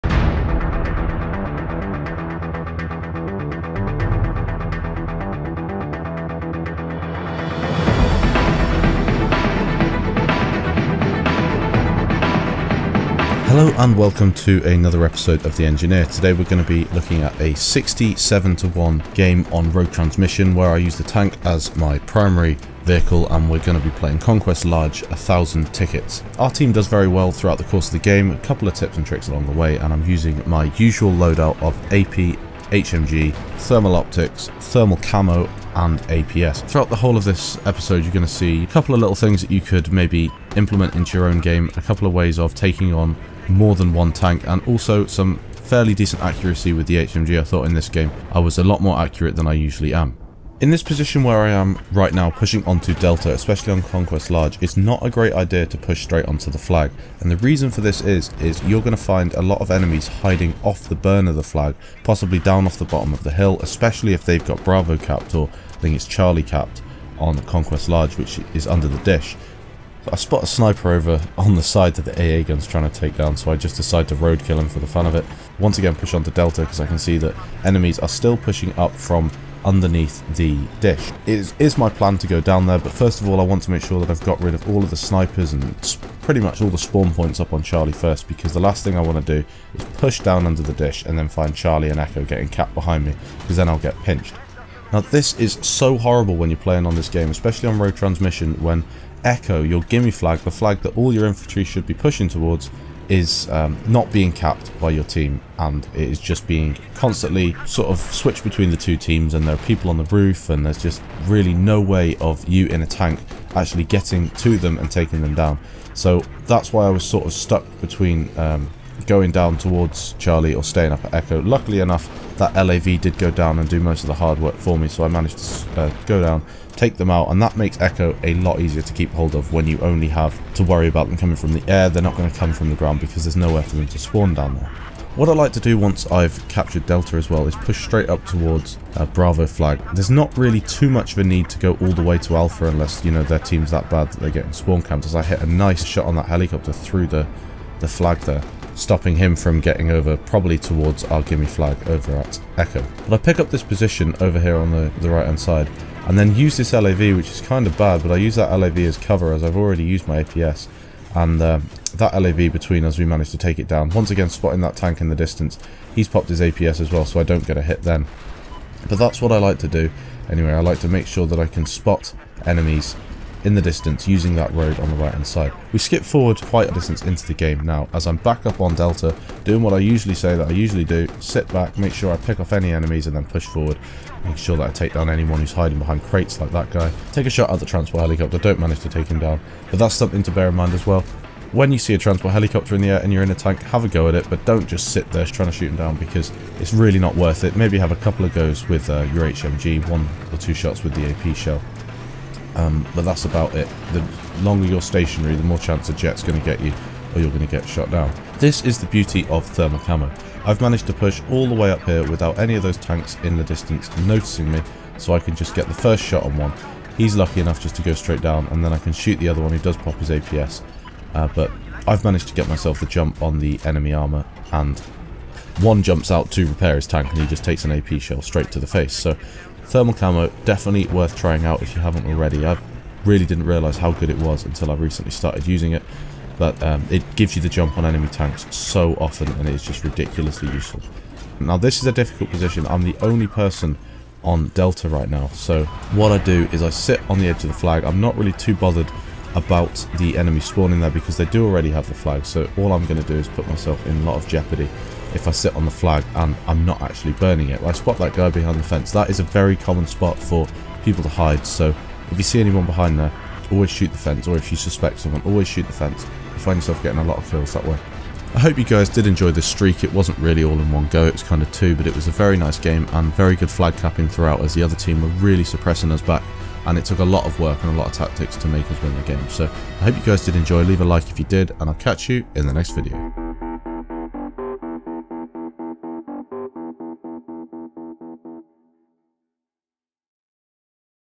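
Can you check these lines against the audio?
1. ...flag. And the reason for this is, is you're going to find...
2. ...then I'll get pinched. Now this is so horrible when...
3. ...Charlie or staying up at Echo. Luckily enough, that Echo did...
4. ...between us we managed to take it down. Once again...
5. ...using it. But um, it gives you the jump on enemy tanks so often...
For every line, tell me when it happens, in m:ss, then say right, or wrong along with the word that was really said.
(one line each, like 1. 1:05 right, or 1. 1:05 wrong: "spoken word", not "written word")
1. 0:56 right
2. 1:33 right
3. 2:00 wrong: "LAV", not "Echo"
4. 2:42 right
5. 3:55 right.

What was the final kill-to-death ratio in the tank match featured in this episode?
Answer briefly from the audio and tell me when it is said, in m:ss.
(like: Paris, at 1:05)
67 to 1, at 0:17.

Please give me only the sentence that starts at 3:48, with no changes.
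So Thermal camo, definitely worth trying out if you haven't already.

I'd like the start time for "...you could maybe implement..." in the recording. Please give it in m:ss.
0:39.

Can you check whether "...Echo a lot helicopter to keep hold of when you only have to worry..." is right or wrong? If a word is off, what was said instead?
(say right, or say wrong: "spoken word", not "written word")
wrong: "easier", not "helicopter".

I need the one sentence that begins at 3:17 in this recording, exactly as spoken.
Maybe have a couple of goes with uh, your HMG, one or two shots with the AP shell.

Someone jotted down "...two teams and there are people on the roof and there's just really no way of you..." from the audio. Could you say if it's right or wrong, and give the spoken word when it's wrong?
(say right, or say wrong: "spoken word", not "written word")
right.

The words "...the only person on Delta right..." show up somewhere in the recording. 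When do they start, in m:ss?
4:02.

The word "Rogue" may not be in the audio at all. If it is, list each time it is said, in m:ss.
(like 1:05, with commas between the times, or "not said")
0:19, 1:37.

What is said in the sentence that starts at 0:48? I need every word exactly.
I was a lot more accurate than I usually am.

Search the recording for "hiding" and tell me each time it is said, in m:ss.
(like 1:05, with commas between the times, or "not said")
1:00, 3:05.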